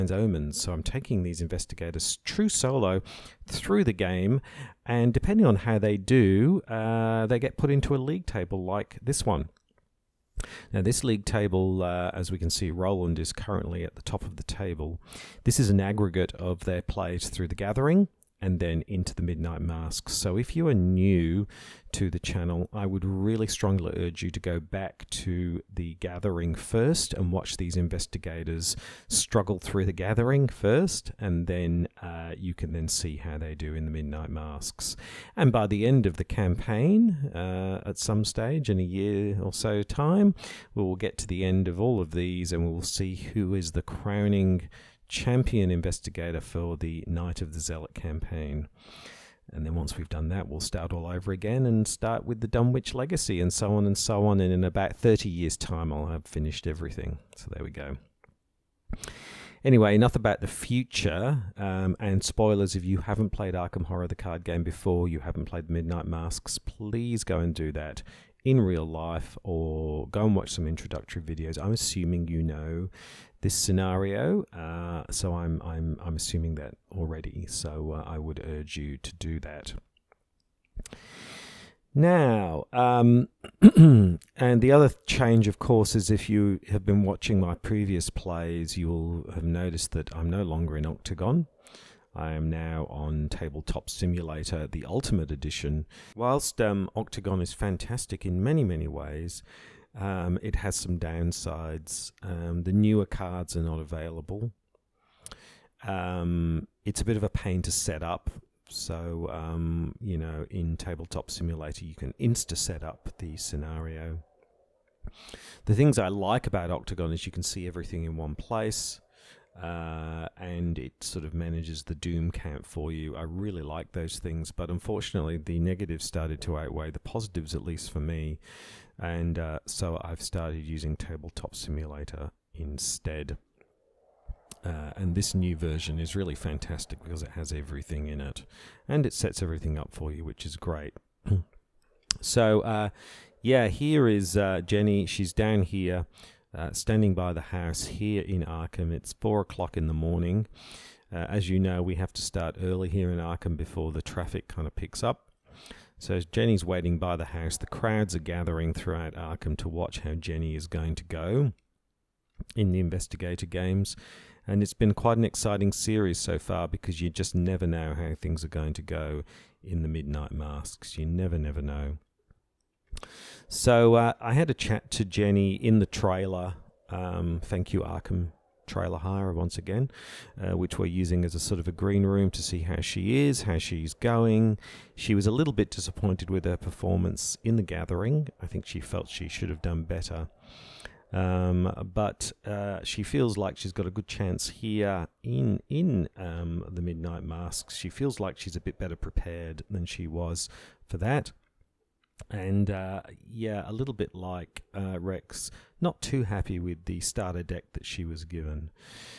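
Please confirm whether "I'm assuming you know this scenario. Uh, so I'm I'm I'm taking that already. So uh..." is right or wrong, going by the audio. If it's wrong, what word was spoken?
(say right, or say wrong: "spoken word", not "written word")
wrong: "assuming", not "taking".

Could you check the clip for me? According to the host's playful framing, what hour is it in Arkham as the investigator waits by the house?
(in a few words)
4 o'clock in the morning.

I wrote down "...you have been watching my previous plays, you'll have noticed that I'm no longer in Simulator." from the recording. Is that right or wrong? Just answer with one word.
wrong.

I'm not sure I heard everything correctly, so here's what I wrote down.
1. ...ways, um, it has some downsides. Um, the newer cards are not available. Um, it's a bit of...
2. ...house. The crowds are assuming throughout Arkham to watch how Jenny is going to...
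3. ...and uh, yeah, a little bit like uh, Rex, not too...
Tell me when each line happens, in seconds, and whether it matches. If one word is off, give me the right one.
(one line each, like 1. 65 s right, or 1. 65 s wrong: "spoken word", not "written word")
1. 98 s right
2. 157 s wrong: "gathering", not "assuming"
3. 202 s right.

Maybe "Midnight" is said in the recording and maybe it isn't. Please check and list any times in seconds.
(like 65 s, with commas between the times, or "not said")
19 s, 33 s, 65 s, 169 s, 196 s.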